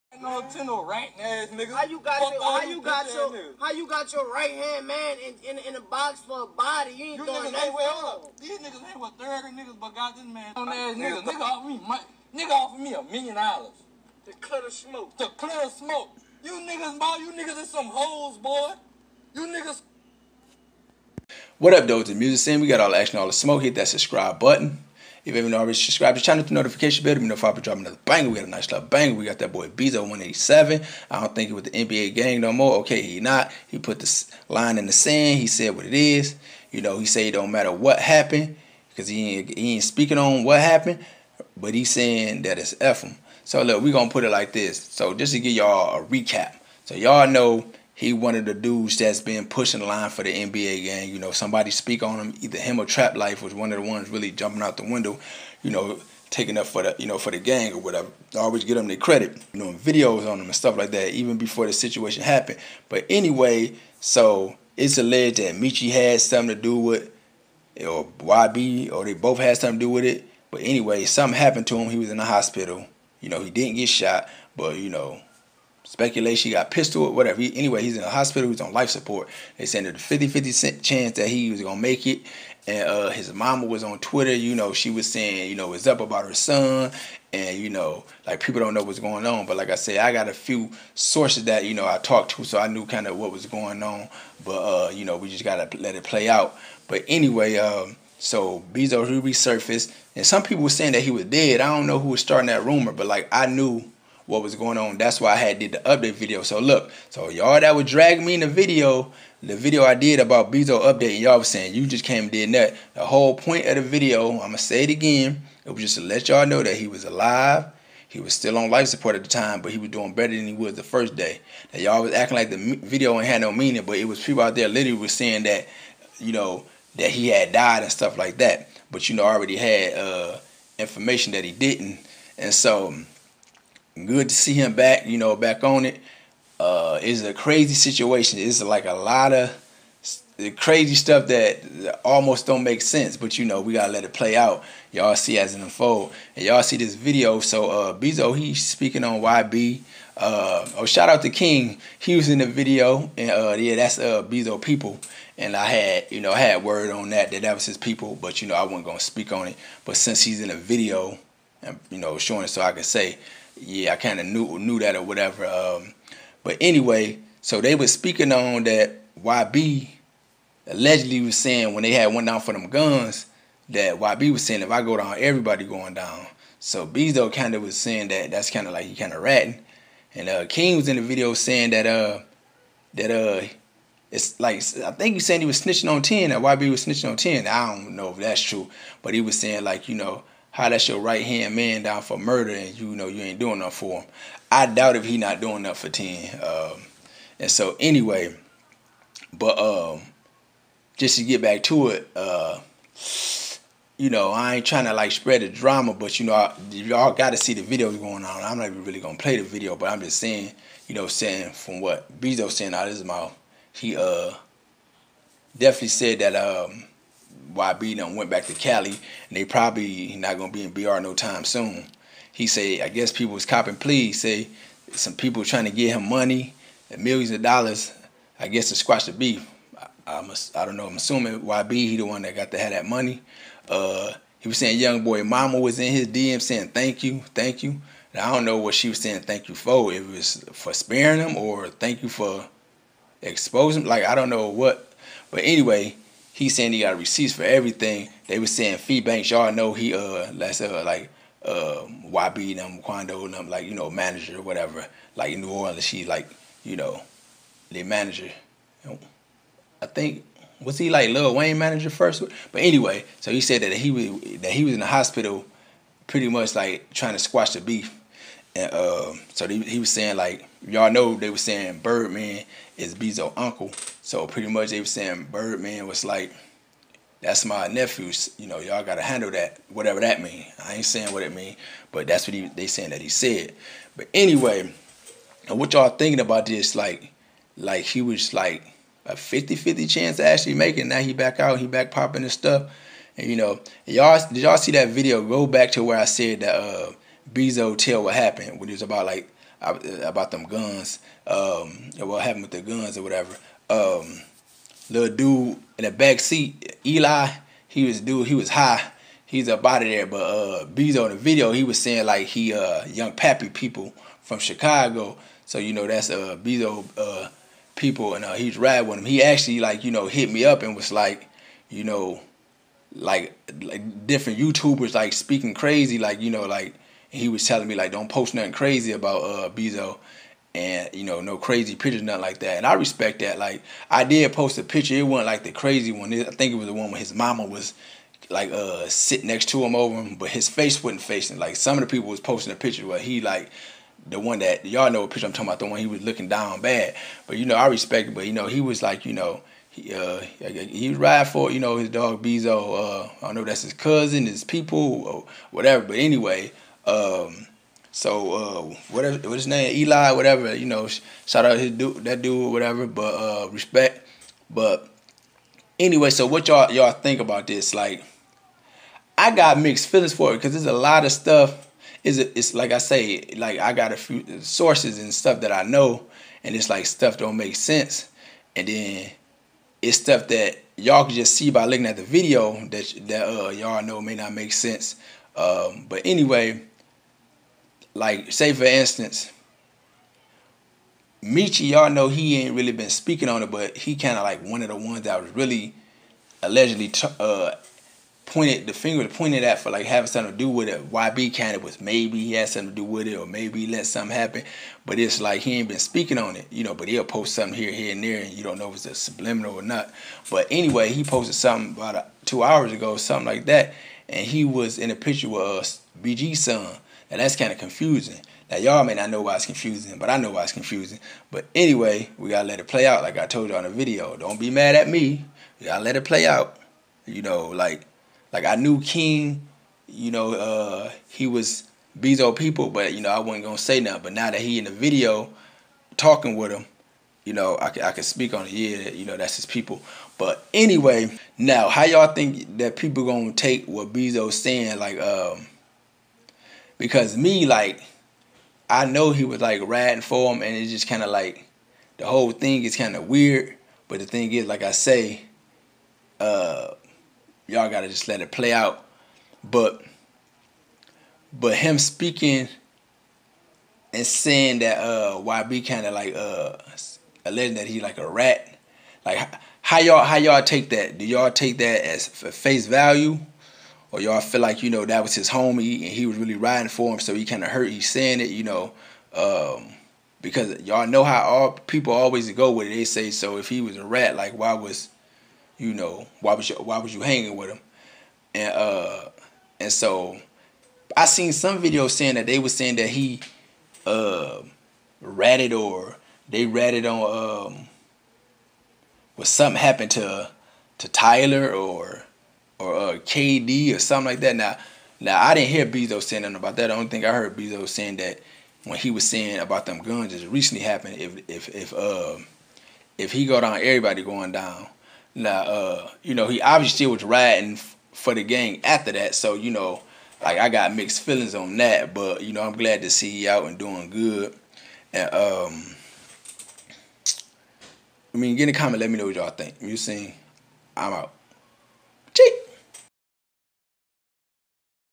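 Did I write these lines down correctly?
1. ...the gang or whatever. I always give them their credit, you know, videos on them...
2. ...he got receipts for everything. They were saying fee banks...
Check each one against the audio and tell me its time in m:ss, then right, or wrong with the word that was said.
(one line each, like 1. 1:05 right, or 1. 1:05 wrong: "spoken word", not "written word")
1. 0:57 right
2. 4:06 right.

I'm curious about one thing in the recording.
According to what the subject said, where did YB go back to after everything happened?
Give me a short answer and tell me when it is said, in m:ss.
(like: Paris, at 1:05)
Cali, at 3:38.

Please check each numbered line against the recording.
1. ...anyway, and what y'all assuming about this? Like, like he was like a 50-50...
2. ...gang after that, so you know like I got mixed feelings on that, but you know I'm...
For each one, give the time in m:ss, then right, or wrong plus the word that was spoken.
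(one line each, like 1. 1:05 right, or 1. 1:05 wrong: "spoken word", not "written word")
1. 4:44 wrong: "thinking", not "assuming"
2. 8:38 right.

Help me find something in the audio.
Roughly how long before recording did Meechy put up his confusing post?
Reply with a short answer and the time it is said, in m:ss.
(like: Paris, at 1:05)
2 hours ago, at 6:52.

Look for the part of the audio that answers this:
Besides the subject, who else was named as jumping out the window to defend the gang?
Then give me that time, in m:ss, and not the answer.
0:52.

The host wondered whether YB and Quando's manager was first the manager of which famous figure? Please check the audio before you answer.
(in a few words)
Lil Wayne.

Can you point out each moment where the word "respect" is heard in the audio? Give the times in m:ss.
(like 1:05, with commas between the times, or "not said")
5:32, 5:47, 6:03.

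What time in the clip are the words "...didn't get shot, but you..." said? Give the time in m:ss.
1:13.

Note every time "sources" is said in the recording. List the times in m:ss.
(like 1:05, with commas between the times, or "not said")
1:30, 6:14.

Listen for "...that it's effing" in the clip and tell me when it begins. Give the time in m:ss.
0:42.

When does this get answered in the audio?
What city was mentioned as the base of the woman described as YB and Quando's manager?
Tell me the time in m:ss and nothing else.
4:15.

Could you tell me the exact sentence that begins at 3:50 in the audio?
I'm assuming YB he the one that got to have that money.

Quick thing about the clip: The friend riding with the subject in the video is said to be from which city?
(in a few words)
Chicago.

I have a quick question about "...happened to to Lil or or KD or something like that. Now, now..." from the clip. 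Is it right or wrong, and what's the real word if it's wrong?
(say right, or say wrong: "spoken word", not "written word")
wrong: "Tyler", not "Lil".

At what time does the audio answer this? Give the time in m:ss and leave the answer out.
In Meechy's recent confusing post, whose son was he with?
6:56.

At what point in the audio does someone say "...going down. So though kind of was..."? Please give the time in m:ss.
2:55.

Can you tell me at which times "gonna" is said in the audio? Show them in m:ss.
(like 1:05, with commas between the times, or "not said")
0:43, 2:38, 3:28, 3:40.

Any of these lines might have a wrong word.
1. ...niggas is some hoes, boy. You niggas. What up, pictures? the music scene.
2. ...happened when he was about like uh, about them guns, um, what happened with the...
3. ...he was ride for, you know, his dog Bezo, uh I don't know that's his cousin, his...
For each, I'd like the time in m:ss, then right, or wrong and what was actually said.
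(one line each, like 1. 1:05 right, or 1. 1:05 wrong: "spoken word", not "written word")
1. 0:17 wrong: "dudes", not "pictures"
2. 4:58 right
3. 5:50 right.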